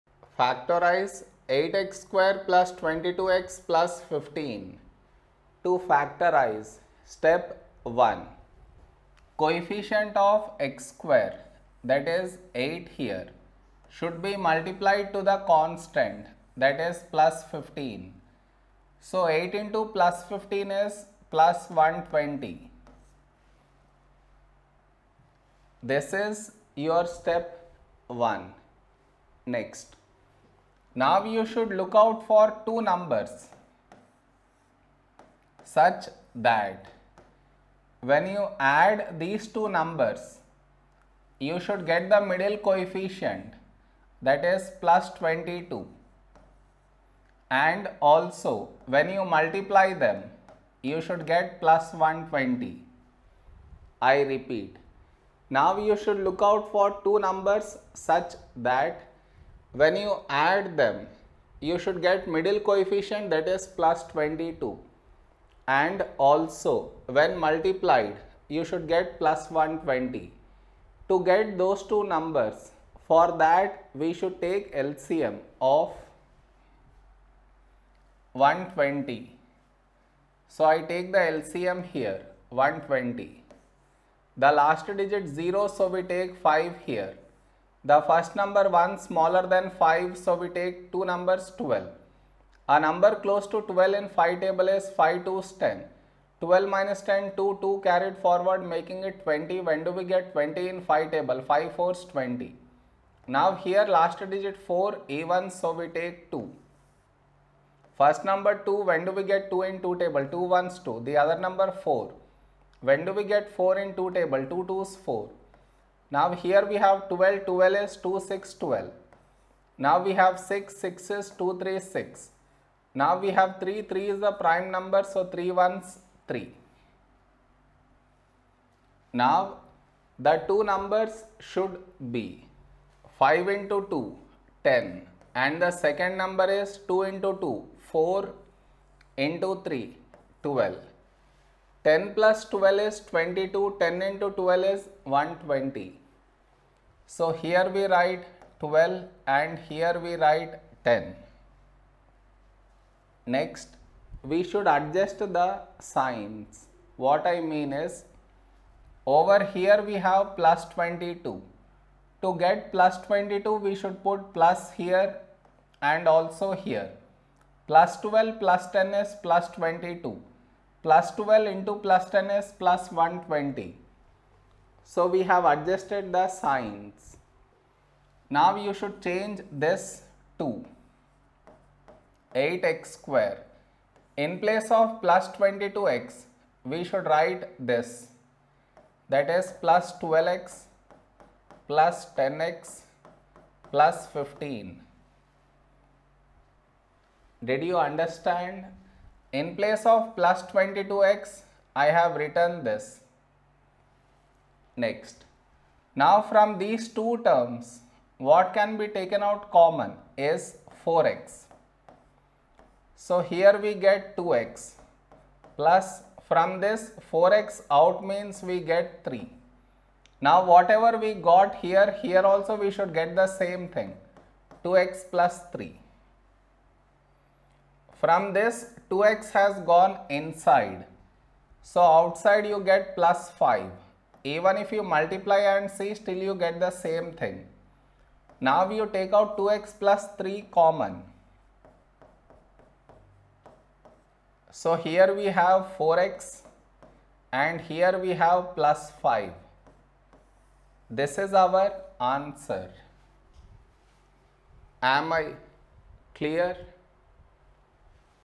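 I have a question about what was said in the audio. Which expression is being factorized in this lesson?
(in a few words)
8x² + 22x + 15.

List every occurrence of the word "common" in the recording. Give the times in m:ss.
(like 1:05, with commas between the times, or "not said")
3:29, 4:00.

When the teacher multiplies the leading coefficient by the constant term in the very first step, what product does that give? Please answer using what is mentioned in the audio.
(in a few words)
120.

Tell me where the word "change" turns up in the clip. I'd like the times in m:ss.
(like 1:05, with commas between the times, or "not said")
2:59.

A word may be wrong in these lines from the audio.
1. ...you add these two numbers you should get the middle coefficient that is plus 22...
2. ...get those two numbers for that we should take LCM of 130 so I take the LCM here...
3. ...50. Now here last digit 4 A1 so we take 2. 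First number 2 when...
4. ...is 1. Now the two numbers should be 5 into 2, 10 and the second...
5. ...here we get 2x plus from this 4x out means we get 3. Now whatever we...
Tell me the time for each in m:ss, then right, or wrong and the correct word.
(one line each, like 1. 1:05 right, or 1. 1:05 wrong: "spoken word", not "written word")
1. 0:38 right
2. 1:11 wrong: "120", not "130"
3. 1:42 wrong: "20", not "50"
4. 2:05 wrong: "3", not "1"
5. 3:33 right.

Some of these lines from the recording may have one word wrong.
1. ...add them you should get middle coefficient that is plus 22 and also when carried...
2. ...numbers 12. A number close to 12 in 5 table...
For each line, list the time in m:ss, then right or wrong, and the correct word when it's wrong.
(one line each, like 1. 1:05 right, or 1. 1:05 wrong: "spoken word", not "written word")
1. 1:00 wrong: "multiplied", not "carried"
2. 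1:31 right.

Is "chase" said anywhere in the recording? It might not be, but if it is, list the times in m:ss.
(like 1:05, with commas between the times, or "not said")
not said.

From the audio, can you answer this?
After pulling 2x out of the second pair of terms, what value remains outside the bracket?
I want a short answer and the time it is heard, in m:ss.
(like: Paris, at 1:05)
plus 5, at 3:51.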